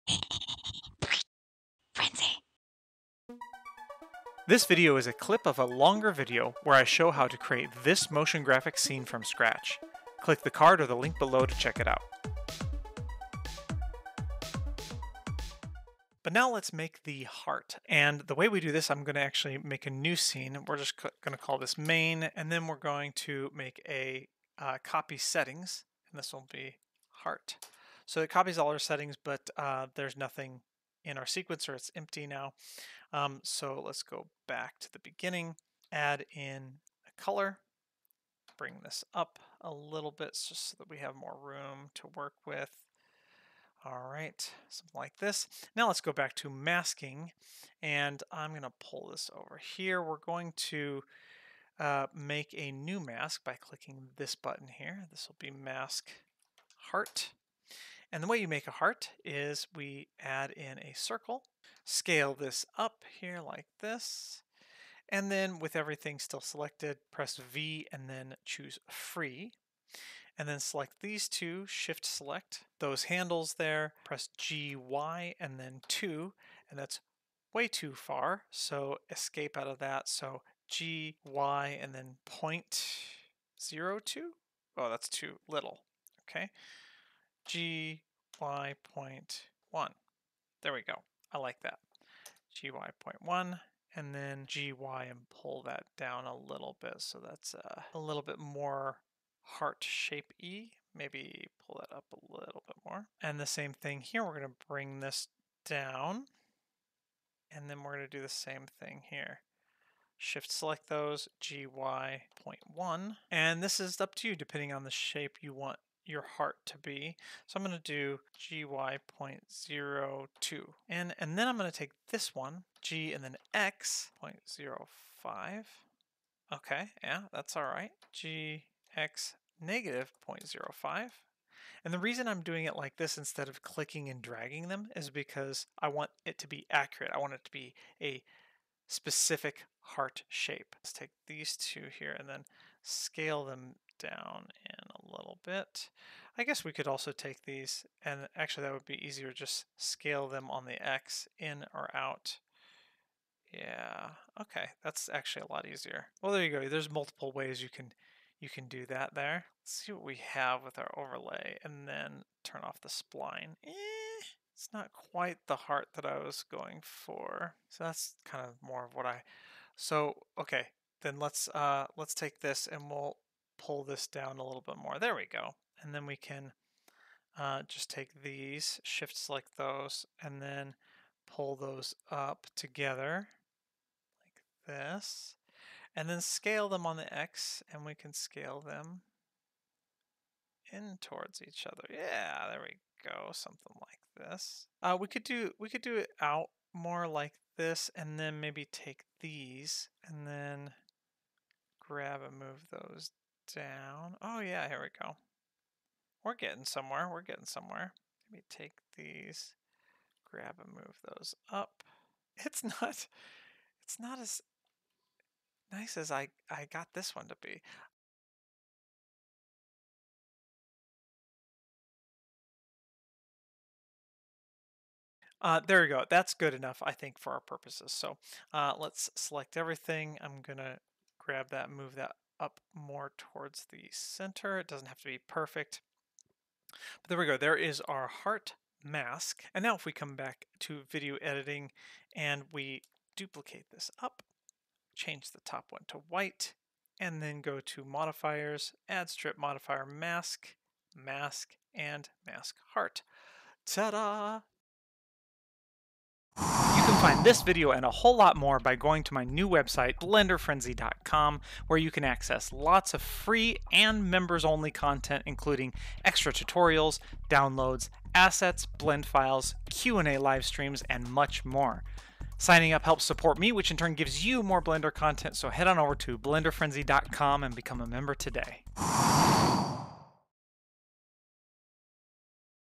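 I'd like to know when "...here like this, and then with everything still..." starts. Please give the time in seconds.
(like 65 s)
63 s.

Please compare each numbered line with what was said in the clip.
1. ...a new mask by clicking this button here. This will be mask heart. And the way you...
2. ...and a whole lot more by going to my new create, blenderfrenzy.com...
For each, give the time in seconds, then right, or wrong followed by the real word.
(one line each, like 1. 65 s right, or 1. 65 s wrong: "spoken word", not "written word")
1. 52 s right
2. 257 s wrong: "website", not "create".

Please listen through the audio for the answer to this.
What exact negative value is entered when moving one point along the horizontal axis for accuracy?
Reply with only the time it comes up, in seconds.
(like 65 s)
129 s.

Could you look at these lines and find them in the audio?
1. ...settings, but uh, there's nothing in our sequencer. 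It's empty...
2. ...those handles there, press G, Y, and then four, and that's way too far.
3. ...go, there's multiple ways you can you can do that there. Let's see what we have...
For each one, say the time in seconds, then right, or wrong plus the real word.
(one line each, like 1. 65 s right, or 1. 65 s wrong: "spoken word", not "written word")
1. 28 s right
2. 72 s wrong: "two", not "four"
3. 156 s right.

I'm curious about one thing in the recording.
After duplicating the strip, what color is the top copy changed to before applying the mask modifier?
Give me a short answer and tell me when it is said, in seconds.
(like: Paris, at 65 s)
white, at 246 s.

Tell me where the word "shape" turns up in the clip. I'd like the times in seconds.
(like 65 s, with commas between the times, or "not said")
99 s, 114 s, 140 s.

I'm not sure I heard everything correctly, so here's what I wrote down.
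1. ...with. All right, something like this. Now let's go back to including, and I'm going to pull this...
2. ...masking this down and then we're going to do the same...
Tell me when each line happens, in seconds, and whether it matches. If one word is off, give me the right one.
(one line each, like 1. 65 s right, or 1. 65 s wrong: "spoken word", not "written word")
1. 42 s wrong: "masking", not "including"
2. 104 s wrong: "bring", not "masking".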